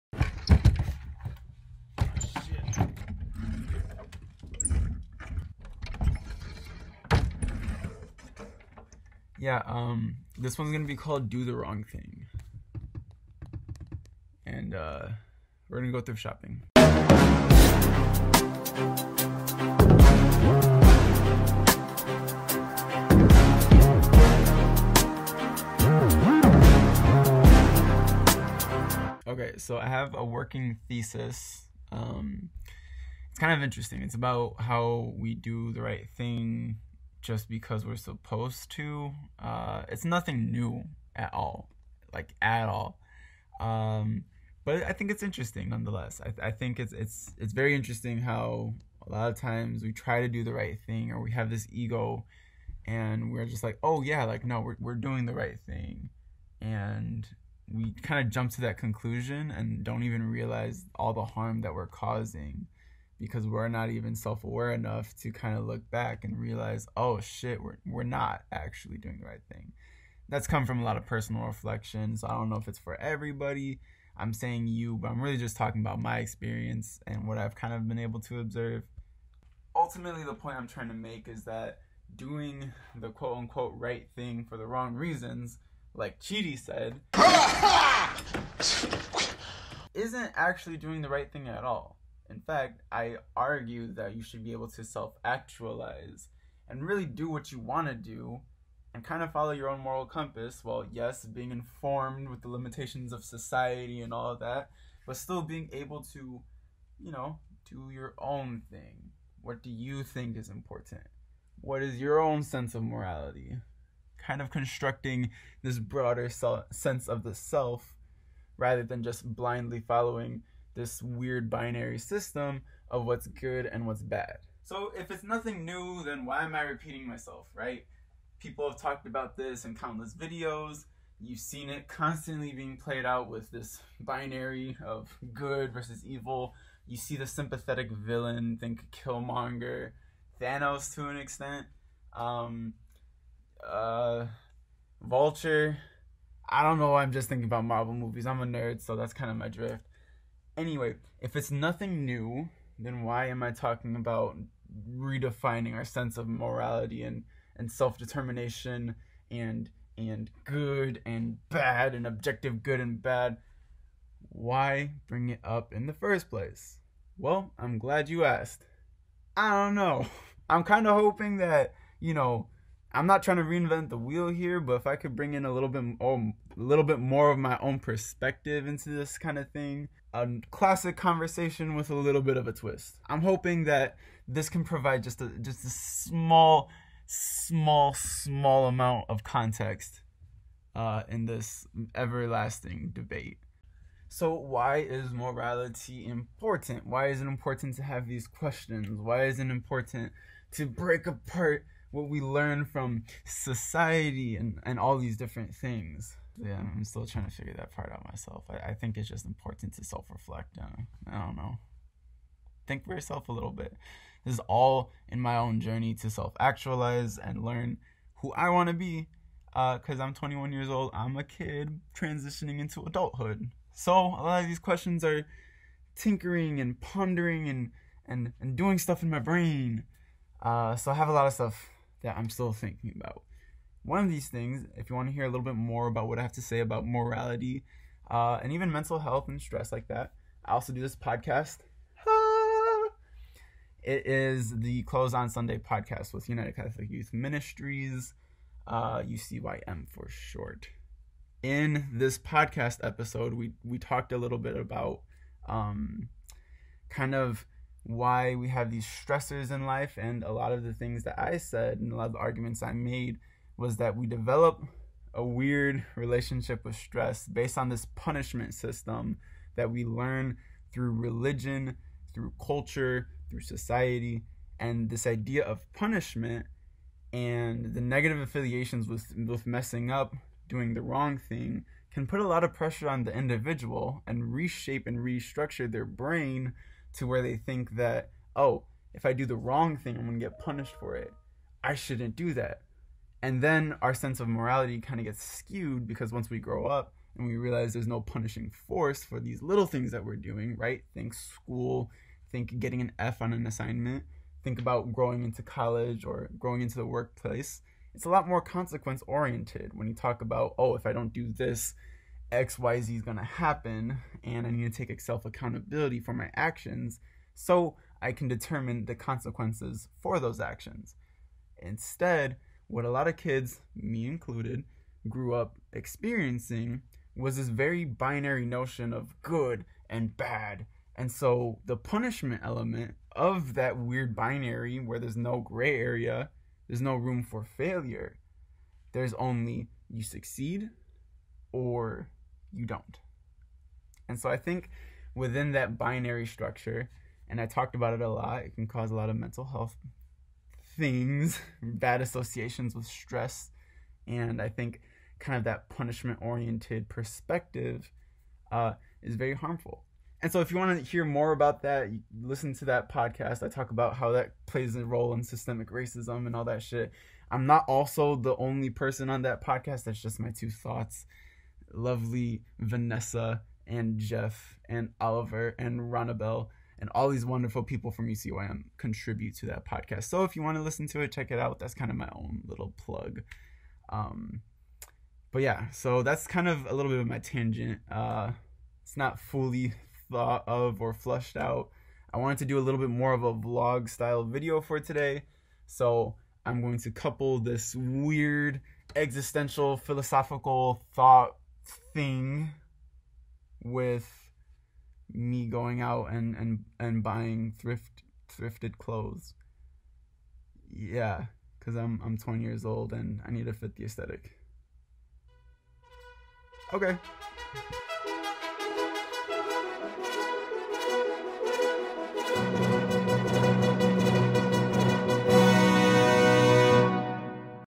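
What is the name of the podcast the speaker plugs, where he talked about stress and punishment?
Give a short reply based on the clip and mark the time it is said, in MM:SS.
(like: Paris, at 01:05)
Close on Sunday, at 04:04.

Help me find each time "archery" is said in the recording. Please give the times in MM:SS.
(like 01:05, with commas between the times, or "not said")
not said.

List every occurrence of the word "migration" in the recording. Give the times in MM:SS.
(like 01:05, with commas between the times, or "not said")
not said.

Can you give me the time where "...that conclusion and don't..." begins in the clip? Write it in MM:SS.
00:58.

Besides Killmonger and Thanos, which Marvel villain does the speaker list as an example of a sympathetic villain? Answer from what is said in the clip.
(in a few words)
Vulture.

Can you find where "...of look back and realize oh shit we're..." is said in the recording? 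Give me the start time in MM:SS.
01:05.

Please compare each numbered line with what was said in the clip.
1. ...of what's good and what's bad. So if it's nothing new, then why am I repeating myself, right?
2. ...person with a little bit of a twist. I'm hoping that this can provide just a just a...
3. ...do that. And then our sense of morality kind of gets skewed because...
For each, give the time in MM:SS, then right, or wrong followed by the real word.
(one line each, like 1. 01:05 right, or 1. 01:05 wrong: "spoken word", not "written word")
1. 02:02 right
2. 03:00 wrong: "conversation", not "person"
3. 04:52 right.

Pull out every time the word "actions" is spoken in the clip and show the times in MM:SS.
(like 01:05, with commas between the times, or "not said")
05:16, 05:20.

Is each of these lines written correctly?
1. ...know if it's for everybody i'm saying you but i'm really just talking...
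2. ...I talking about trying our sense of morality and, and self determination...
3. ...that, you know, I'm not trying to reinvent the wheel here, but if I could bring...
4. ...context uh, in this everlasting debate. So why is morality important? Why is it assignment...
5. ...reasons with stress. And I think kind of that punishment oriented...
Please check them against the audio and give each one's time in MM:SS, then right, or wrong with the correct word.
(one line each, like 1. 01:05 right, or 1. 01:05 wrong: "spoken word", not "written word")
1. 01:12 right
2. 02:33 wrong: "redefining", not "trying"
3. 02:51 right
4. 03:09 wrong: "important", not "assignment"
5. 05:52 wrong: "associations", not "reasons".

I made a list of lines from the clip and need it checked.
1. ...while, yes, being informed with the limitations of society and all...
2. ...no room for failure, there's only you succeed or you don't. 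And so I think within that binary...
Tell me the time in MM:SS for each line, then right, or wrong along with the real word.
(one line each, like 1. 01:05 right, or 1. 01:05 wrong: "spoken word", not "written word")
1. 01:40 right
2. 05:36 right.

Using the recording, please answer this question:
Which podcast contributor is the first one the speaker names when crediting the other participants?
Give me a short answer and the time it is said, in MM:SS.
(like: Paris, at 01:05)
Vanessa, at 06:12.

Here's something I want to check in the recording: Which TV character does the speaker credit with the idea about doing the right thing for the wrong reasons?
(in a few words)
Chidi.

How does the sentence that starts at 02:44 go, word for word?
Why bring it up in the first place?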